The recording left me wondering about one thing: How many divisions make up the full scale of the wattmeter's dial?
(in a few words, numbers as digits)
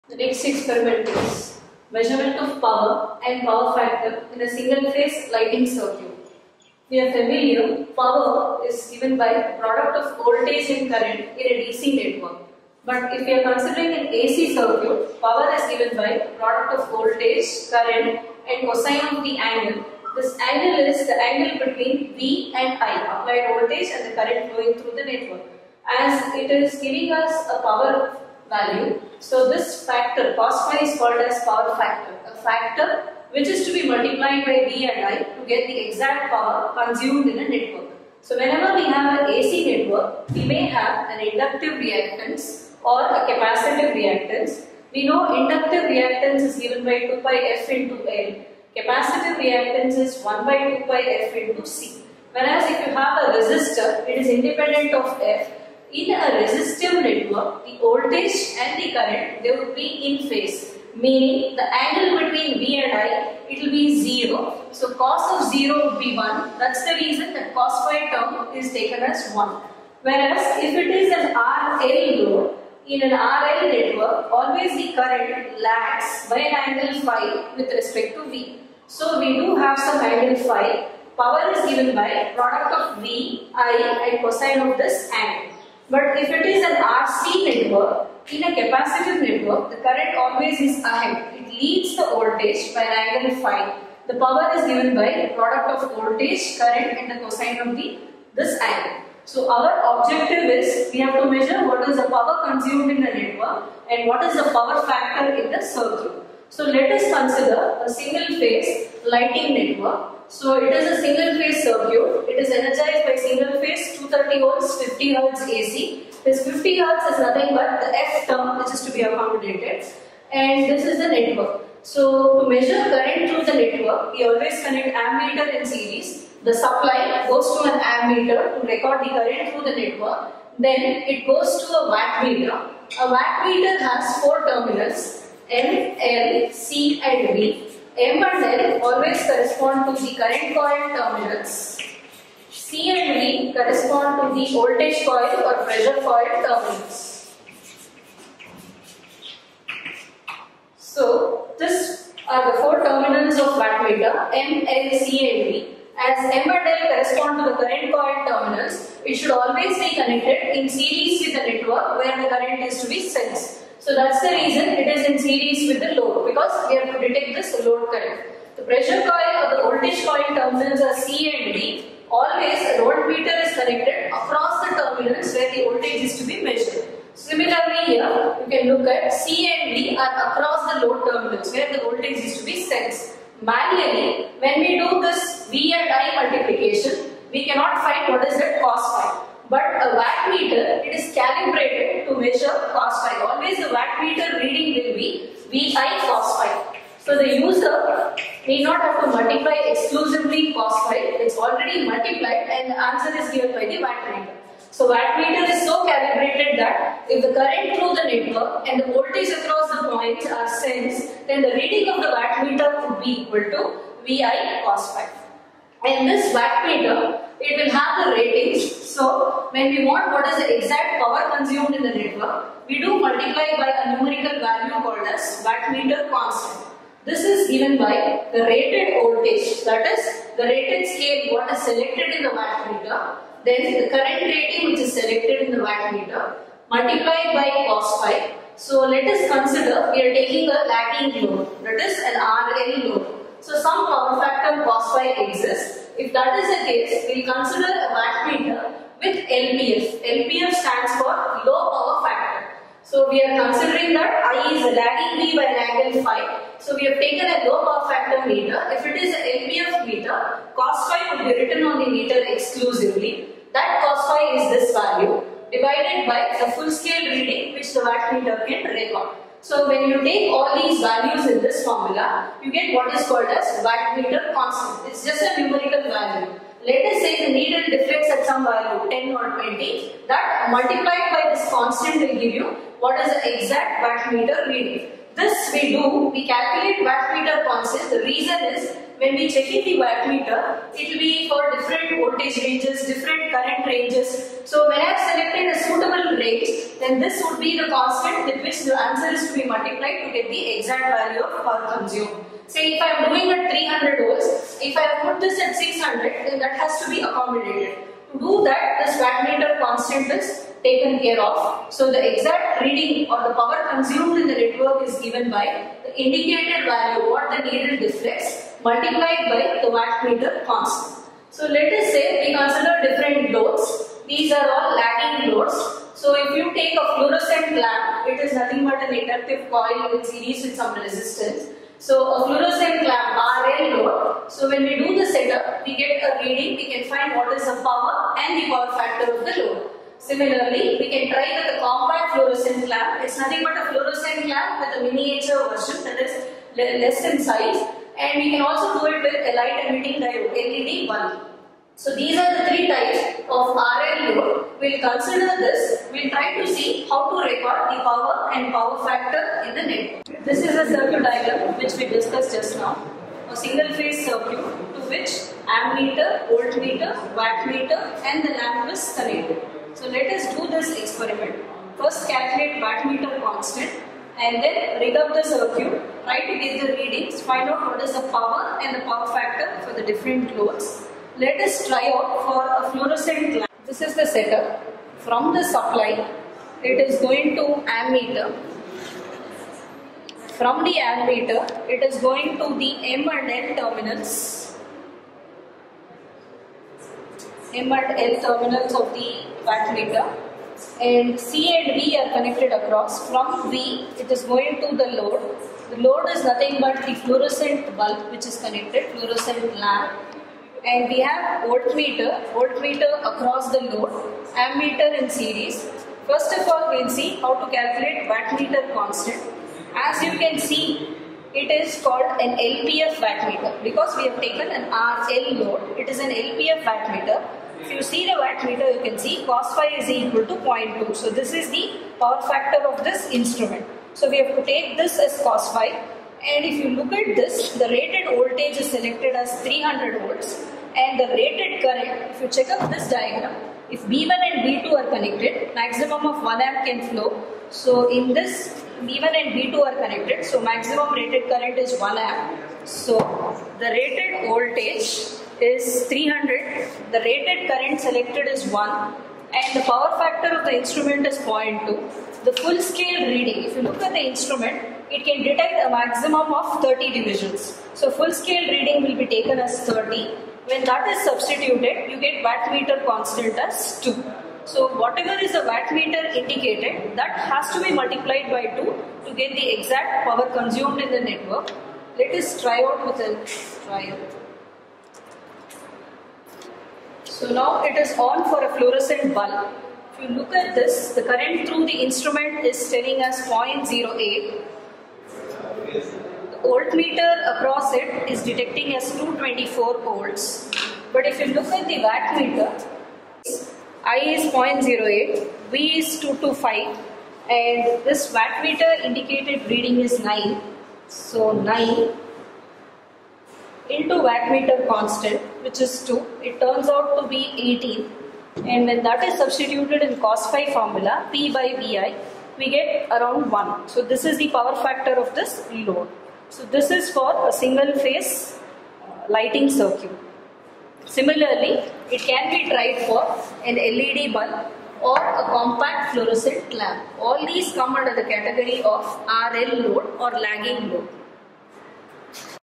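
30.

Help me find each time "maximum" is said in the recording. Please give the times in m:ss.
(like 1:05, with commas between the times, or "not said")
7:25, 7:30, 7:45.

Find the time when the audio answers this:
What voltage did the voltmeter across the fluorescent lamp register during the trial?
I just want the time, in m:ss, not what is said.
8:18.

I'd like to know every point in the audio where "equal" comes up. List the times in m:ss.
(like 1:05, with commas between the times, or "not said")
3:33, 7:09.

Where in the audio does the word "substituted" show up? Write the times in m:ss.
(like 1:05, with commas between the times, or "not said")
7:51, 8:39.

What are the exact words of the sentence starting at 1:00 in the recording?
Meaning the angle between V and I, it will be 0.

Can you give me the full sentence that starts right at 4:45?
This we do, we calculate wattmeter constant.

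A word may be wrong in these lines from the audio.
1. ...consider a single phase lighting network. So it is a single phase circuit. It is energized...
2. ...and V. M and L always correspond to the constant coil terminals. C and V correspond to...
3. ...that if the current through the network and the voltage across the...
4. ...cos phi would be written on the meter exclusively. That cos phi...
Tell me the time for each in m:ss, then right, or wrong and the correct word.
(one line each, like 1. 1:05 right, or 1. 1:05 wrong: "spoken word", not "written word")
1. 1:47 right
2. 2:17 wrong: "current", not "constant"
3. 3:26 right
4. 4:20 right.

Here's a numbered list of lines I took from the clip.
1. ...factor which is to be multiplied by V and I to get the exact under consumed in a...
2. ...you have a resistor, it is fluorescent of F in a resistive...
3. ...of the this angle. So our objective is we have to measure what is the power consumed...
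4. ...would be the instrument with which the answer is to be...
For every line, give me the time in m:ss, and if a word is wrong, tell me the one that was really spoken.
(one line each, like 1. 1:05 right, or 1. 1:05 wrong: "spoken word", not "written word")
1. 0:32 wrong: "power", not "under"
2. 0:52 wrong: "independent", not "fluorescent"
3. 1:37 right
4. 4:57 wrong: "constant", not "instrument".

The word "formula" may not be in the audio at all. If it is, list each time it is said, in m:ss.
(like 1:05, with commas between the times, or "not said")
4:31, 8:40.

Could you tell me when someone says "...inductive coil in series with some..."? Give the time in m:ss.
5:28.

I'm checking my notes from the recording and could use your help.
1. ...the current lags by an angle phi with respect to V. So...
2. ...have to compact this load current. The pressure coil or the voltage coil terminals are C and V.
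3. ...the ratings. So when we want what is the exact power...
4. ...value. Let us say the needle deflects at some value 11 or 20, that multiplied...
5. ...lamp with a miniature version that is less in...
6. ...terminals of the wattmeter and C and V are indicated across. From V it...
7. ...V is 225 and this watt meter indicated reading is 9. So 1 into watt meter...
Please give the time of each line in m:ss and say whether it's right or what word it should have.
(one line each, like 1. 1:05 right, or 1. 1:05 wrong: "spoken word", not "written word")
1. 1:14 right
2. 2:46 wrong: "detect", not "compact"
3. 3:38 right
4. 4:35 wrong: "10", not "11"
5. 5:44 right
6. 6:38 wrong: "connected", not "indicated"
7. 8:25 wrong: "9", not "1".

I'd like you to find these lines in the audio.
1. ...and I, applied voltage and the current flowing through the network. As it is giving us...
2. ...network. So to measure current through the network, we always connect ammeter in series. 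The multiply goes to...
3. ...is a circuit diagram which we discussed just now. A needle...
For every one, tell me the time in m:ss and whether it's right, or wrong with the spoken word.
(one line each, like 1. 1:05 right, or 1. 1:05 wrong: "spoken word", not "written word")
1. 0:22 right
2. 2:01 wrong: "supply", not "multiply"
3. 6:00 wrong: "single", not "needle".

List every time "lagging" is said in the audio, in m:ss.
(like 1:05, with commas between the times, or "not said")
4:00, 4:14, 5:24, 9:00.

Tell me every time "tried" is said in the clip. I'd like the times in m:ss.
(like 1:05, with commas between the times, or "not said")
8:52.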